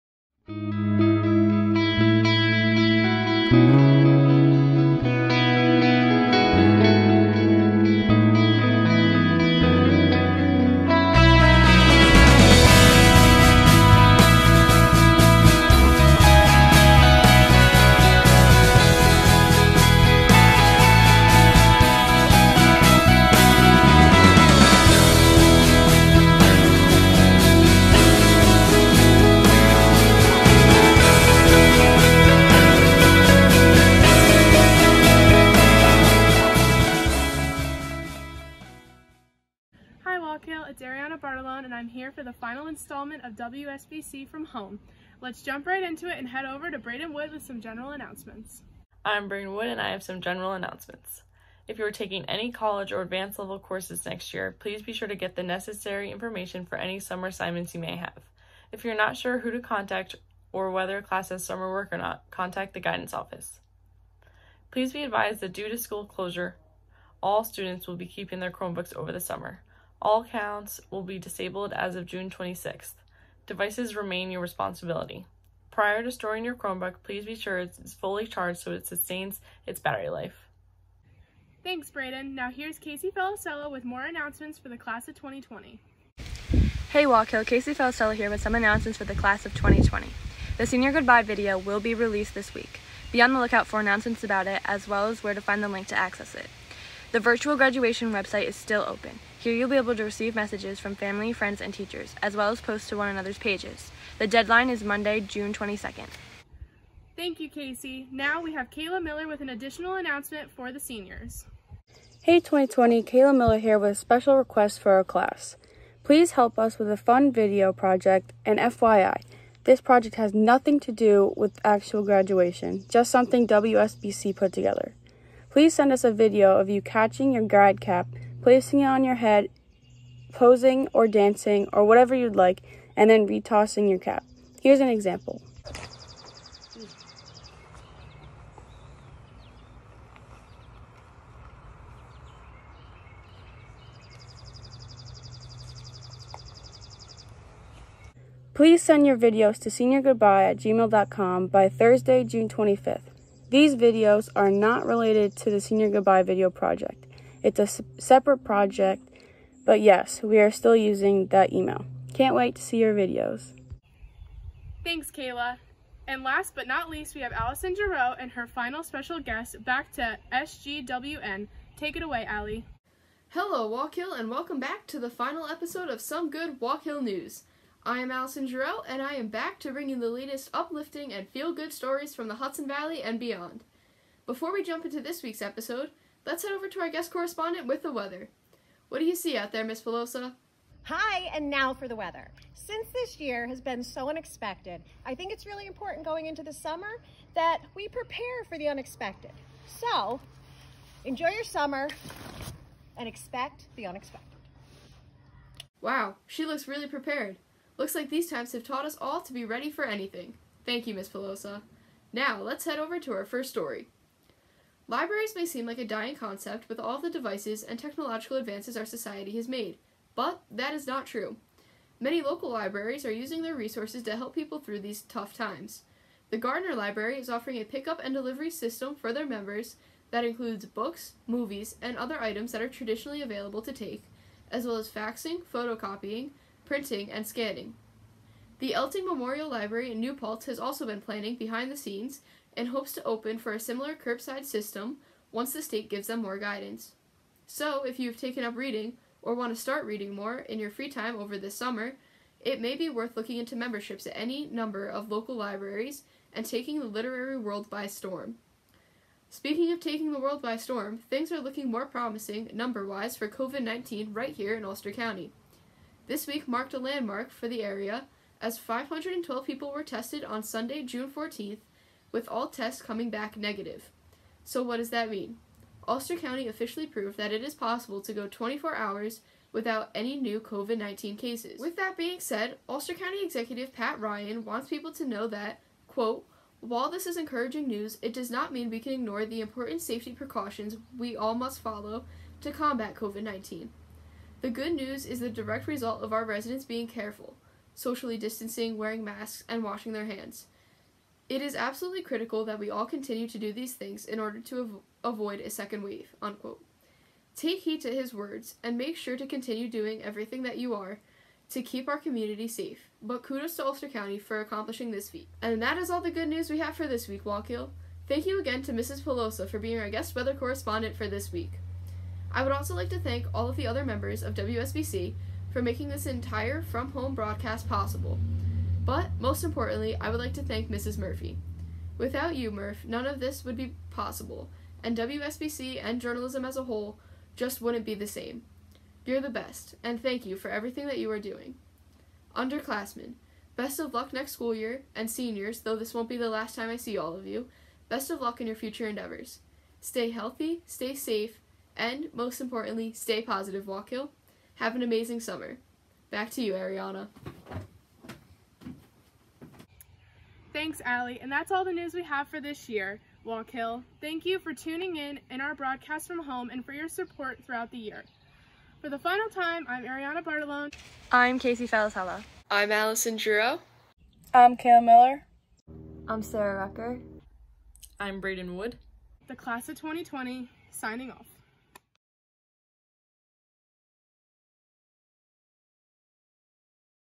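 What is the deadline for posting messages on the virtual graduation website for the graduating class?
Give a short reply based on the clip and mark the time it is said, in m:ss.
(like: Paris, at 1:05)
Monday, June 22nd, at 1:44.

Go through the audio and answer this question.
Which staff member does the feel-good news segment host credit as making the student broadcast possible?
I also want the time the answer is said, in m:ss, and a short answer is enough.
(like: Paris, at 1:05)
Mrs. Murphy, at 5:30.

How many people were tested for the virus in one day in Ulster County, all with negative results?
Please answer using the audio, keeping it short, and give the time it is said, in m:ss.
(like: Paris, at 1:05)
512, at 4:28.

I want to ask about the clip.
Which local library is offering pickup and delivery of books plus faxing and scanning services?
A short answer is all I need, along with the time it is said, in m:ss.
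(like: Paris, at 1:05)
Gardiner Library, at 3:46.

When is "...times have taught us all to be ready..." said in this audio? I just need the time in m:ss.
3:28.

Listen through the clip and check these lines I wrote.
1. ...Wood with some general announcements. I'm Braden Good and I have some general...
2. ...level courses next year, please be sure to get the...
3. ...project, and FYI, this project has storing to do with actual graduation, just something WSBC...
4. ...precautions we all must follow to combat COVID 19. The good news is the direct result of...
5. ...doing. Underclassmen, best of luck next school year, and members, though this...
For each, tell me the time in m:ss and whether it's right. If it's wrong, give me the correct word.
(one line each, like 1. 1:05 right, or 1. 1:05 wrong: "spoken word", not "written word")
1. 0:47 wrong: "Wood", not "Good"
2. 0:53 right
3. 1:57 wrong: "nothing", not "storing"
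4. 4:50 right
5. 5:41 wrong: "seniors", not "members".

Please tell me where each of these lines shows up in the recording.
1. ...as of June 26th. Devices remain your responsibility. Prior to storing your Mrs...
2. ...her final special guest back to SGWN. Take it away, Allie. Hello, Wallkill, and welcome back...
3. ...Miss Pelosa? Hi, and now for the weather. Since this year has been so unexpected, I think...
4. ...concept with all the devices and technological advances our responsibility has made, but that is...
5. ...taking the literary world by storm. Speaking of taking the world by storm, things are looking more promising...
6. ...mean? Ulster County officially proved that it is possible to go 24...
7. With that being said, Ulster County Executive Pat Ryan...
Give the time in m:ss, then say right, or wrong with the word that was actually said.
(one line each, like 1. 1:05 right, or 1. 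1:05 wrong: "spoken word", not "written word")
1. 1:11 wrong: "Chromebook", not "Mrs"
2. 2:48 right
3. 3:09 right
4. 3:36 wrong: "society", not "responsibility"
5. 4:16 right
6. 4:35 right
7. 4:41 right.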